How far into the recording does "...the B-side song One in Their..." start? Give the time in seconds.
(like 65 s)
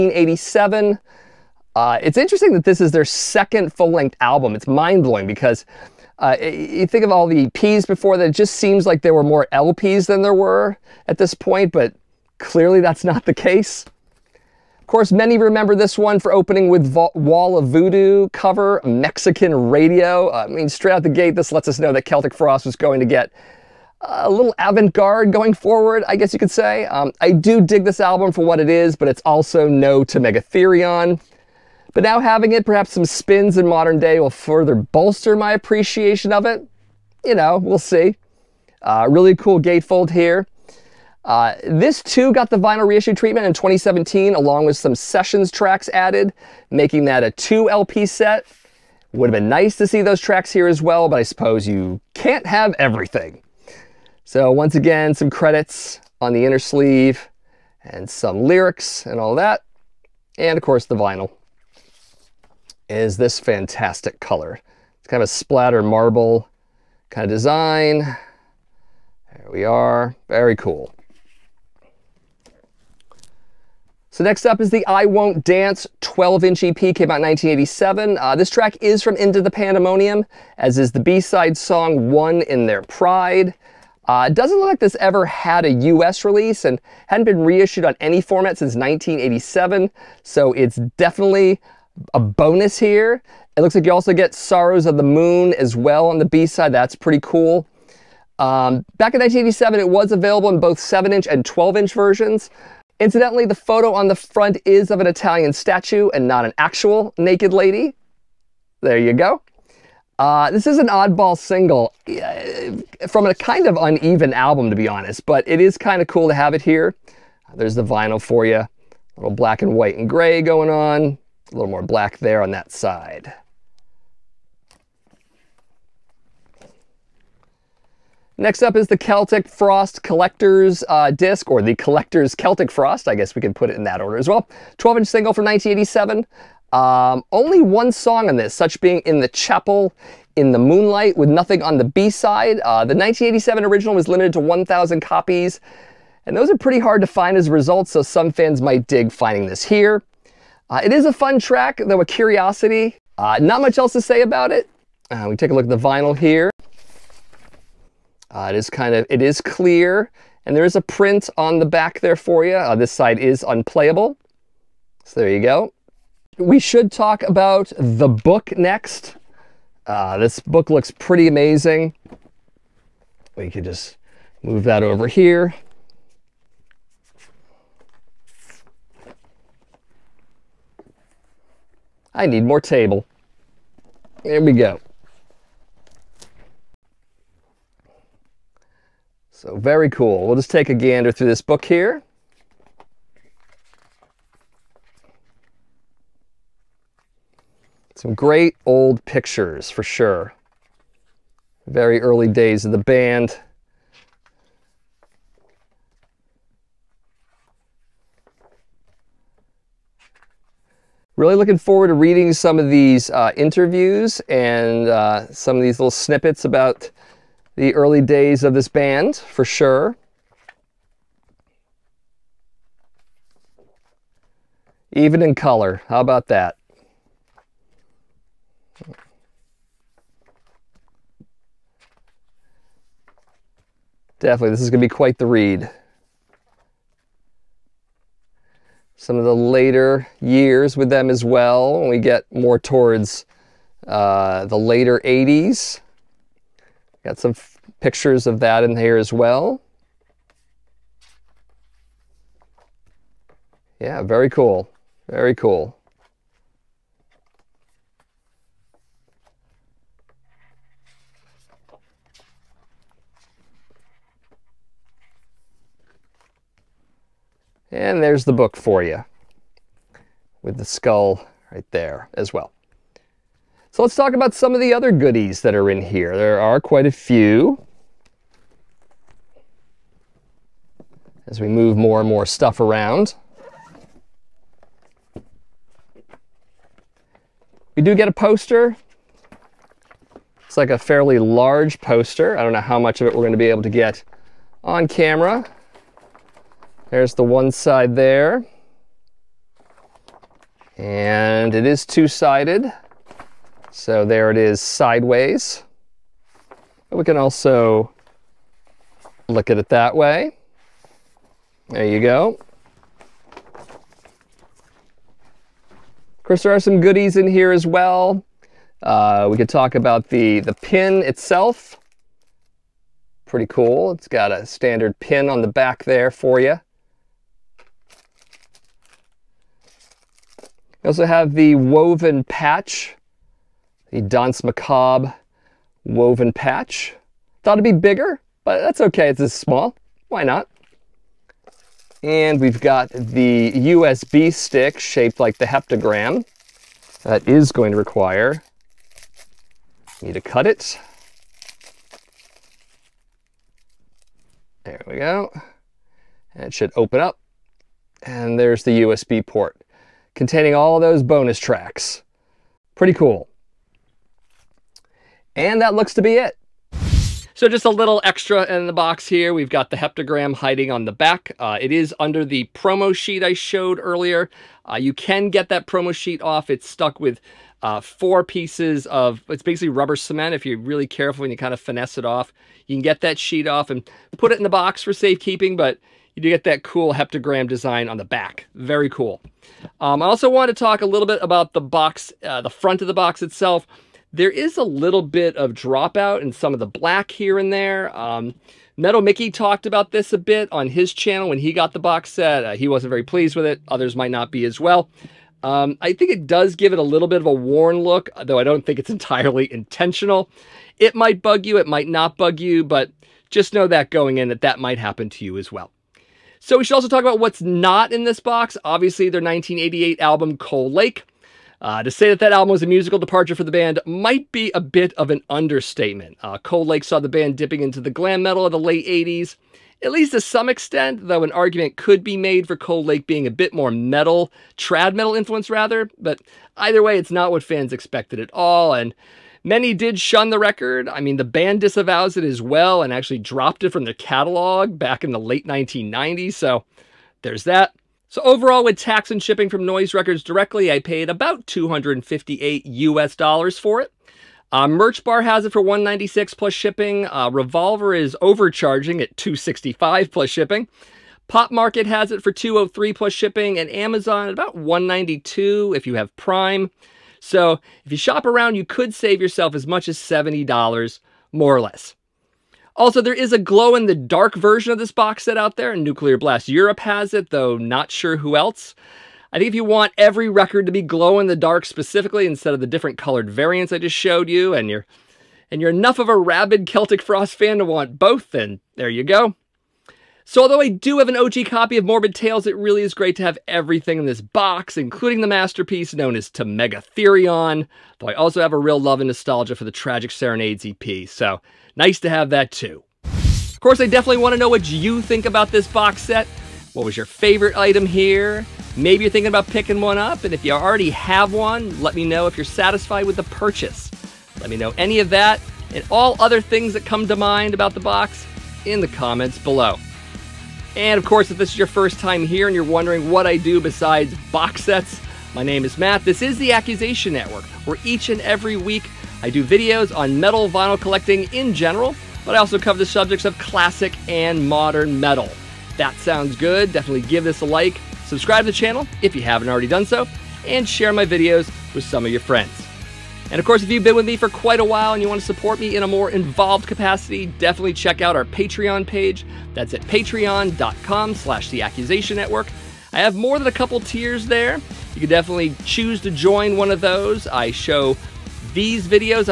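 80 s.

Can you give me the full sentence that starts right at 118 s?
A little black and white and gray going on.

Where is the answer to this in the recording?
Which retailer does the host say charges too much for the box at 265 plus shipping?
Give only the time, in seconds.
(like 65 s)
457 s.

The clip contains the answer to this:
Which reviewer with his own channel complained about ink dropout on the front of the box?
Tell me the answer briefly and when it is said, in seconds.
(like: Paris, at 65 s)
Metal Mickey, at 398 s.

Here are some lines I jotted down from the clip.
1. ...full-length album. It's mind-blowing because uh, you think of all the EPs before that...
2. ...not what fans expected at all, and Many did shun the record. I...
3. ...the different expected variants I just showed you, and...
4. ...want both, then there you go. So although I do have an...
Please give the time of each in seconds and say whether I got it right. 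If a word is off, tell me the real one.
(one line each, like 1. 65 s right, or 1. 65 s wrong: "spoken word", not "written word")
1. 3 s right
2. 437 s right
3. 482 s wrong: "colored", not "expected"
4. 487 s right.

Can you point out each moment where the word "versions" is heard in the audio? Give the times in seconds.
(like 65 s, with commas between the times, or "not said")
101 s, 474 s.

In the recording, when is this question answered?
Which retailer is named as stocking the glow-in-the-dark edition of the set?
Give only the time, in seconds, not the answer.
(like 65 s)
475 s.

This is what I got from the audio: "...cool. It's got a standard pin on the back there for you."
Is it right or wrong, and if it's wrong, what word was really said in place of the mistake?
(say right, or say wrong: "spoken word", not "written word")
right.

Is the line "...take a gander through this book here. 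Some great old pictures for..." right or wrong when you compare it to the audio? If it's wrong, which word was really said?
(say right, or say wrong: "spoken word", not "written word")
right.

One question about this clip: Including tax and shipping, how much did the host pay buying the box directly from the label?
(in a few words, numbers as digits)
258 US dollars.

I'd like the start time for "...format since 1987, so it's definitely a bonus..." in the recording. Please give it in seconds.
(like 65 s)
88 s.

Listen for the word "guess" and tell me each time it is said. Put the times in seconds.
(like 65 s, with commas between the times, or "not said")
26 s, 133 s.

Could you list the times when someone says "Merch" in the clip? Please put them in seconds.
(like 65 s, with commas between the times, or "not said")
454 s.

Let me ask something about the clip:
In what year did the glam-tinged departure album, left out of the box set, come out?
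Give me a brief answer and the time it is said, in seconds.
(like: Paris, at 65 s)
1988, at 419 s.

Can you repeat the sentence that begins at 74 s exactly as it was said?
So next up is the I Won't Dance 12-inch EP, came out in 1987.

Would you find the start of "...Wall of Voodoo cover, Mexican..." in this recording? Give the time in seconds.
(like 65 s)
17 s.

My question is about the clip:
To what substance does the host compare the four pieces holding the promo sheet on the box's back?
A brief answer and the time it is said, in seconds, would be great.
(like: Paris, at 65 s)
rubber cement, at 379 s.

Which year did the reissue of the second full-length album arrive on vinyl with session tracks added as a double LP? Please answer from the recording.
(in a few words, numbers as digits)
2017.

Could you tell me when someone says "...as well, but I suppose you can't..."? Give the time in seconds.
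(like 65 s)
50 s.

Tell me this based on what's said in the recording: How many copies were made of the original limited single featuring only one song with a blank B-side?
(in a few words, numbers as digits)
1,000.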